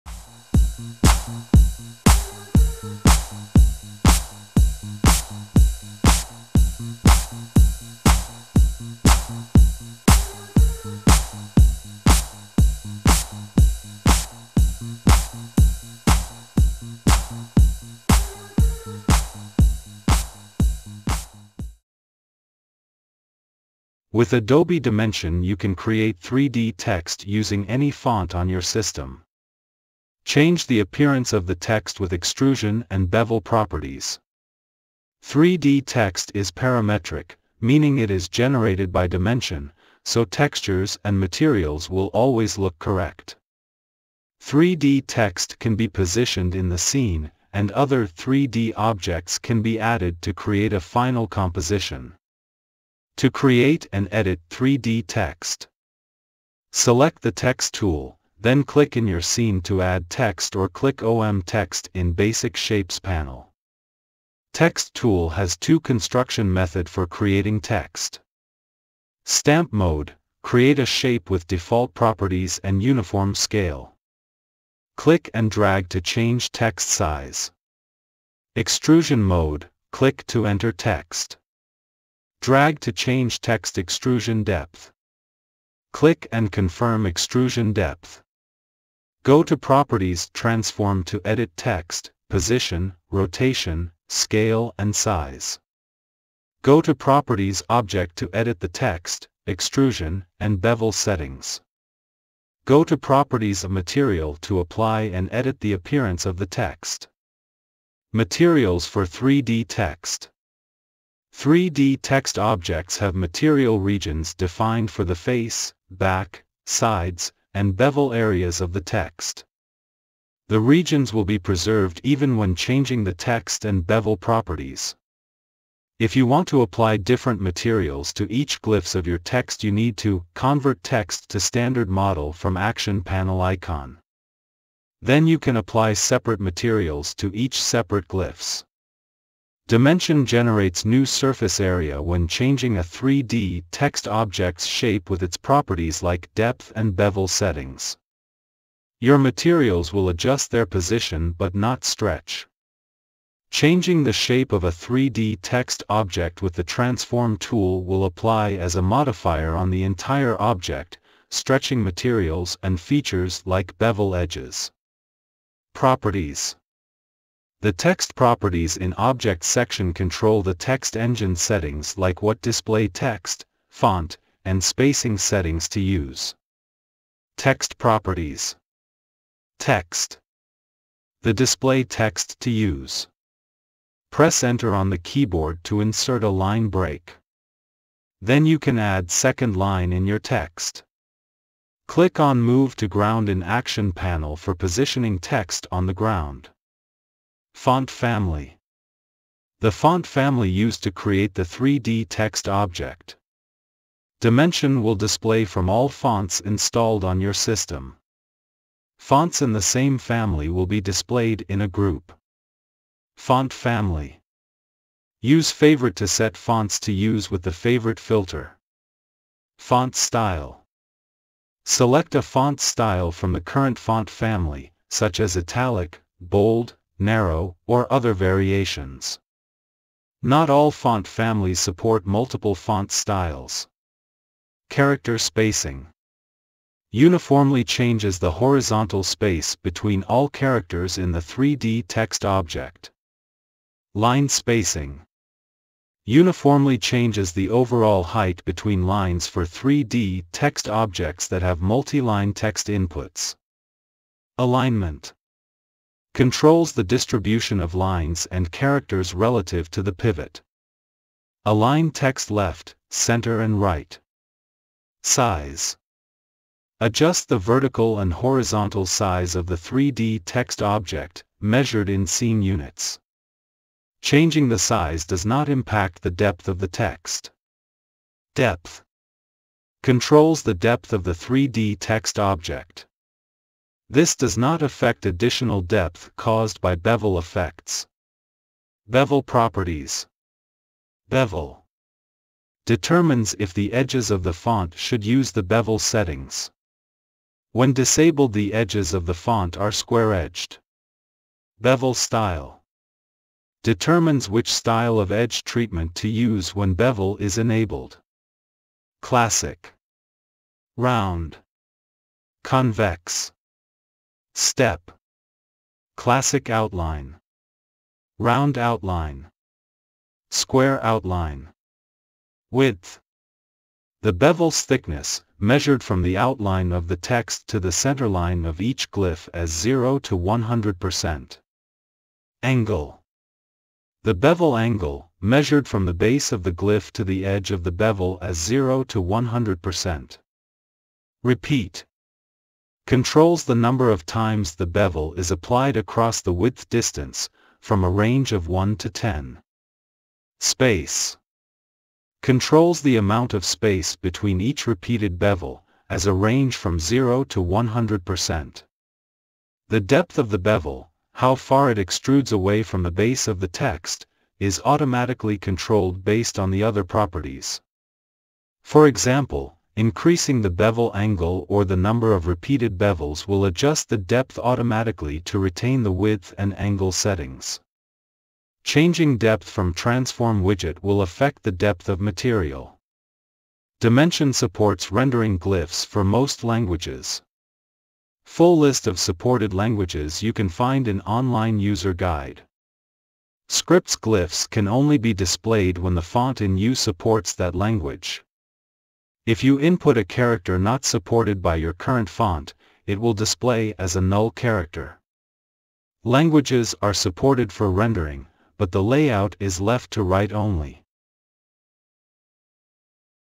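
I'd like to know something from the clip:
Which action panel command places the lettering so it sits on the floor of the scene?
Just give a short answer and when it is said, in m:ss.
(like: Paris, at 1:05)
Move to Ground, at 3:12.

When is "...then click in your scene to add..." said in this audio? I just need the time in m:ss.
0:58.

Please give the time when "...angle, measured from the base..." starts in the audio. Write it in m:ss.
5:34.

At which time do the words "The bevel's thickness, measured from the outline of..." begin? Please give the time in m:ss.
5:24.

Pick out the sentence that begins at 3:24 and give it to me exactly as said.
Dimension will display from all fonts installed on your system.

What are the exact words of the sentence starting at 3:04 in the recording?
Press enter on the keyboard to insert a line break.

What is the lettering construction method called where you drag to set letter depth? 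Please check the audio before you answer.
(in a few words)
Extrusion mode.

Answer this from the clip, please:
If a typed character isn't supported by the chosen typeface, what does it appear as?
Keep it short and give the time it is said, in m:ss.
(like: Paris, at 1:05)
a null character, at 6:44.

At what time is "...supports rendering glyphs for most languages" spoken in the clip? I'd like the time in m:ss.
6:24.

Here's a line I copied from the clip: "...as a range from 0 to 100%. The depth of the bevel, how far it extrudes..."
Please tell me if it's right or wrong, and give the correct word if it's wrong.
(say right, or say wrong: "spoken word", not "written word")
right.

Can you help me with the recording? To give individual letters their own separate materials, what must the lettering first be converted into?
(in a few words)
standard model.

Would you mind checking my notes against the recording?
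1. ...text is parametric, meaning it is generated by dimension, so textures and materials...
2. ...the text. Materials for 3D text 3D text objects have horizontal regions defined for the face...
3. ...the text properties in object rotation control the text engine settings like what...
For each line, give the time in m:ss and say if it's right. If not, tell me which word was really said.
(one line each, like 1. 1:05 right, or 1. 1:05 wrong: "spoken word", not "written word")
1. 0:35 right
2. 1:46 wrong: "material", not "horizontal"
3. 2:47 wrong: "section", not "rotation".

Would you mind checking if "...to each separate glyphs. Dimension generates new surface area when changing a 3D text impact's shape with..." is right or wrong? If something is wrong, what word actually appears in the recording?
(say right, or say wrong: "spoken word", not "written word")
wrong: "object", not "impact".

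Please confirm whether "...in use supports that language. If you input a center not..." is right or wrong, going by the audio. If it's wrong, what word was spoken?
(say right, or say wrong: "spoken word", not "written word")
wrong: "character", not "center".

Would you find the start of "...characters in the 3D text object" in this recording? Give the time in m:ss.
4:00.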